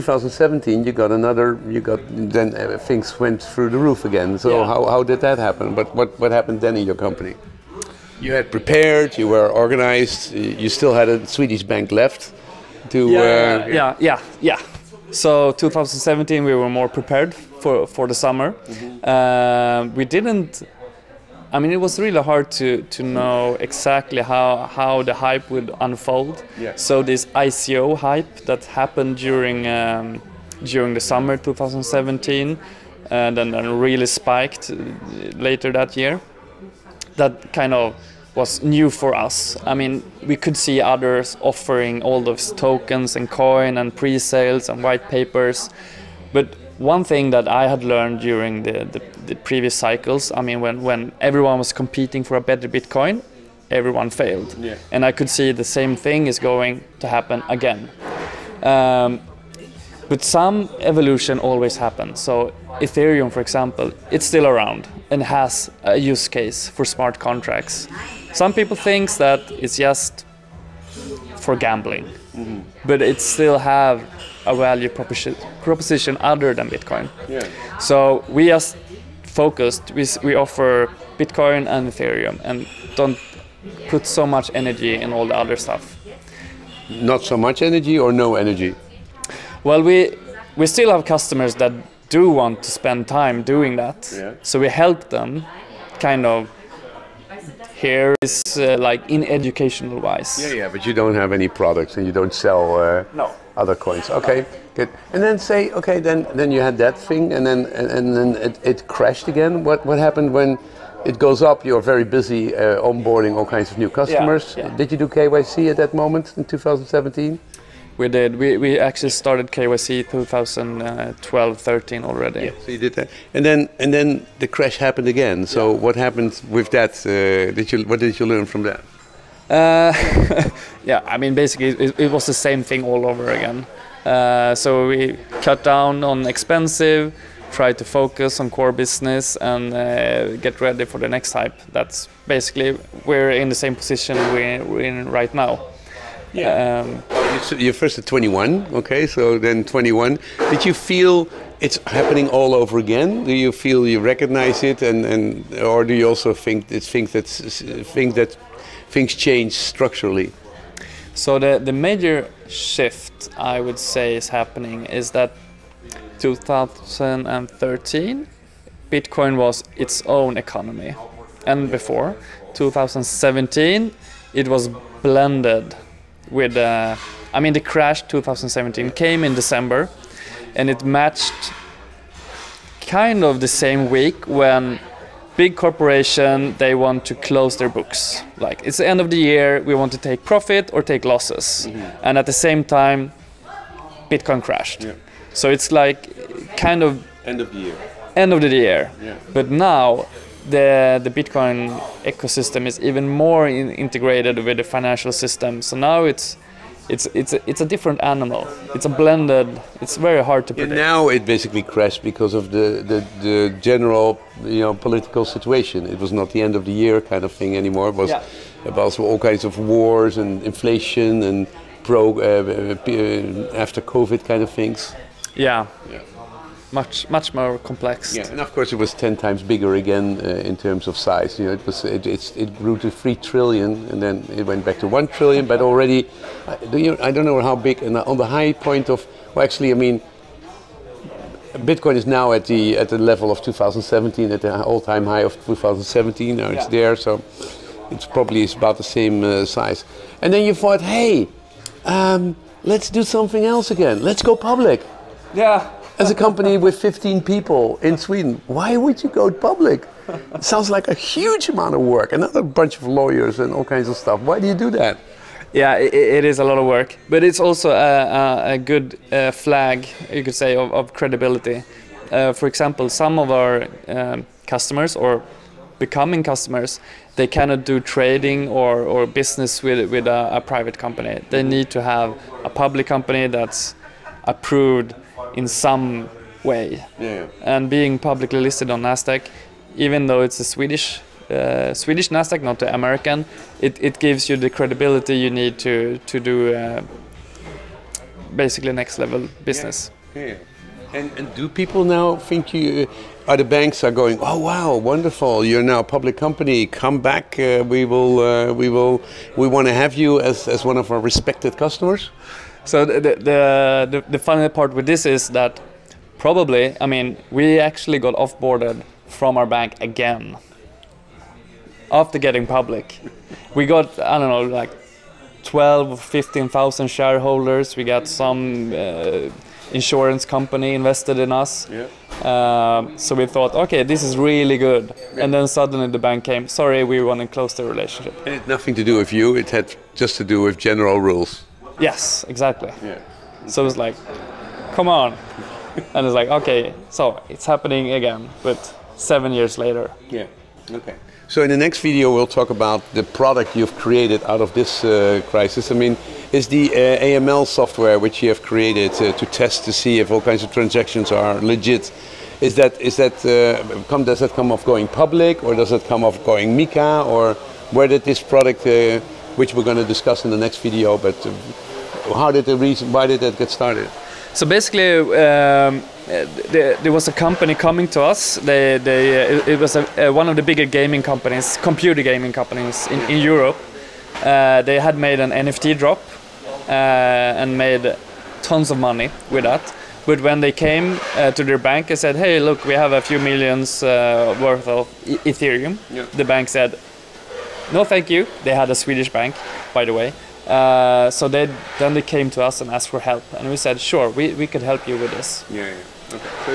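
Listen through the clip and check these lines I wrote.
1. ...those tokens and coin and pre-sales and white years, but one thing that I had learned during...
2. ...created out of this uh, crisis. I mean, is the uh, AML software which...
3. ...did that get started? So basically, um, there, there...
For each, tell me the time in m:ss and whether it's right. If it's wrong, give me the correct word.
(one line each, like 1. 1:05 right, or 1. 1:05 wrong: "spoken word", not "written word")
1. 0:42 wrong: "papers", not "years"
2. 5:53 right
3. 6:13 right.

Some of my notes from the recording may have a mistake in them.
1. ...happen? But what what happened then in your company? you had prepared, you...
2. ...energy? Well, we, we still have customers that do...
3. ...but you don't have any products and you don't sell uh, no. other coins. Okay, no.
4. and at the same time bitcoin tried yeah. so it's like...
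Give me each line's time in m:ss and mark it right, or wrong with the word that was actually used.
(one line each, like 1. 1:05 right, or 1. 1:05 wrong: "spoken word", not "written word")
1. 0:05 right
2. 1:28 right
3. 1:40 right
4. 3:12 wrong: "crashed", not "tried".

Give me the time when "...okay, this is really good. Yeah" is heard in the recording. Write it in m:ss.
5:33.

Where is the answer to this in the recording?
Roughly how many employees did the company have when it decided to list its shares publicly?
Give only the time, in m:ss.
4:16.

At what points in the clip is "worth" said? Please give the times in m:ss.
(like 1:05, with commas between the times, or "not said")
6:33.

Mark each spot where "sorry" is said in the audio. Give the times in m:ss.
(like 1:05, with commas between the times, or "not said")
5:36.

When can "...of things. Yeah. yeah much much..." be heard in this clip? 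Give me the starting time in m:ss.
3:44.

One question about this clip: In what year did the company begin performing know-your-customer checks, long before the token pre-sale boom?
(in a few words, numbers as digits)
2012.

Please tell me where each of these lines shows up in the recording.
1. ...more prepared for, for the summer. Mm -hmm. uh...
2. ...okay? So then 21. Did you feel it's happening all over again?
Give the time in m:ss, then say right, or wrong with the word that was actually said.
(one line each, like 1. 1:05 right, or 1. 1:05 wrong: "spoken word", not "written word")
1. 0:16 right
2. 2:28 right.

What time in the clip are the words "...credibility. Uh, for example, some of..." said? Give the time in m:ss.
4:30.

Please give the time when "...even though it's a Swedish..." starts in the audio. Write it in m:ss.
4:49.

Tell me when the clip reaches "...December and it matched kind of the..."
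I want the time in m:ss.
2:59.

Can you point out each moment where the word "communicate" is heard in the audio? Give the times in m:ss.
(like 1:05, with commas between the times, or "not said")
not said.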